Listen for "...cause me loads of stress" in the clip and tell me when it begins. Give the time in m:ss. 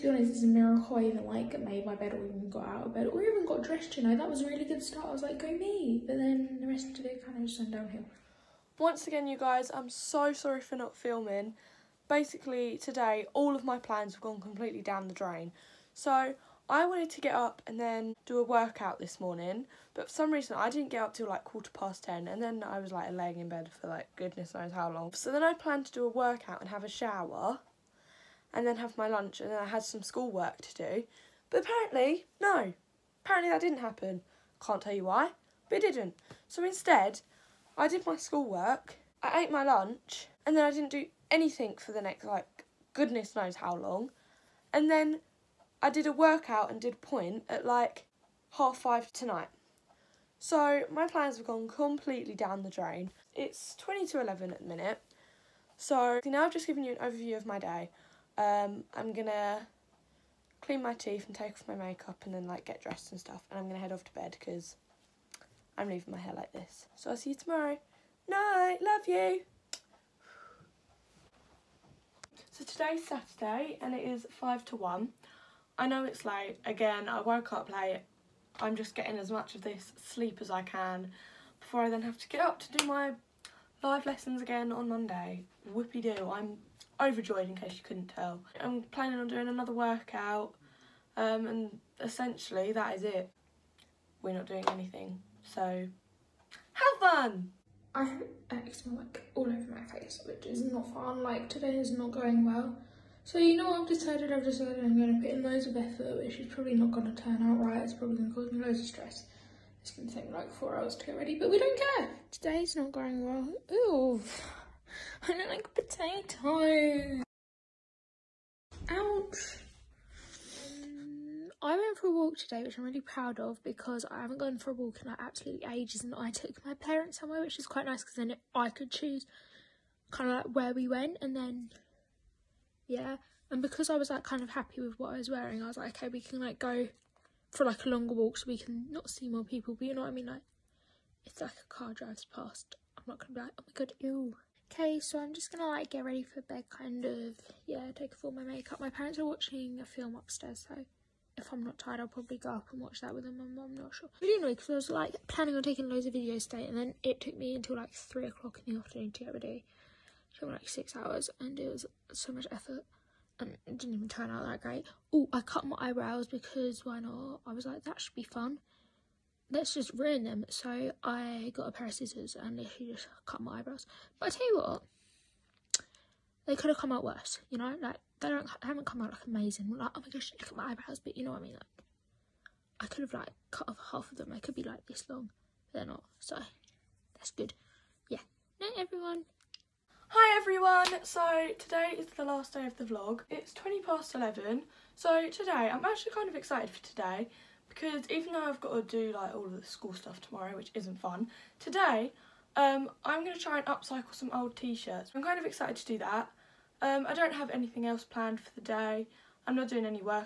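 1:48.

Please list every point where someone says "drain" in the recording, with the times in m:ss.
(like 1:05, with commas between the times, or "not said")
0:15, 0:52.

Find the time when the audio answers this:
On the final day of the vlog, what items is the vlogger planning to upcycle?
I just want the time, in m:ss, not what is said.
3:24.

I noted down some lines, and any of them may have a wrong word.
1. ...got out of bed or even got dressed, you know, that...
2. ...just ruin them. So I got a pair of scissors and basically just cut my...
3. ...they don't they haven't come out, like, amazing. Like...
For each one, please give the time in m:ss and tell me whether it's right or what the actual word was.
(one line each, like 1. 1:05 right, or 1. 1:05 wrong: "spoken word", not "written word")
1. 0:02 right
2. 2:49 wrong: "literally", not "basically"
3. 2:58 right.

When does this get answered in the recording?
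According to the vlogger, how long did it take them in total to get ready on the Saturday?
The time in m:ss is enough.
2:40.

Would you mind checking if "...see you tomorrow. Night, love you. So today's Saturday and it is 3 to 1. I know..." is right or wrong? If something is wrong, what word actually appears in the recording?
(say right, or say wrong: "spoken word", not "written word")
wrong: "5", not "3".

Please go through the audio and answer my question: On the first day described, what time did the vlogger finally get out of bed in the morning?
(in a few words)
quarter past ten.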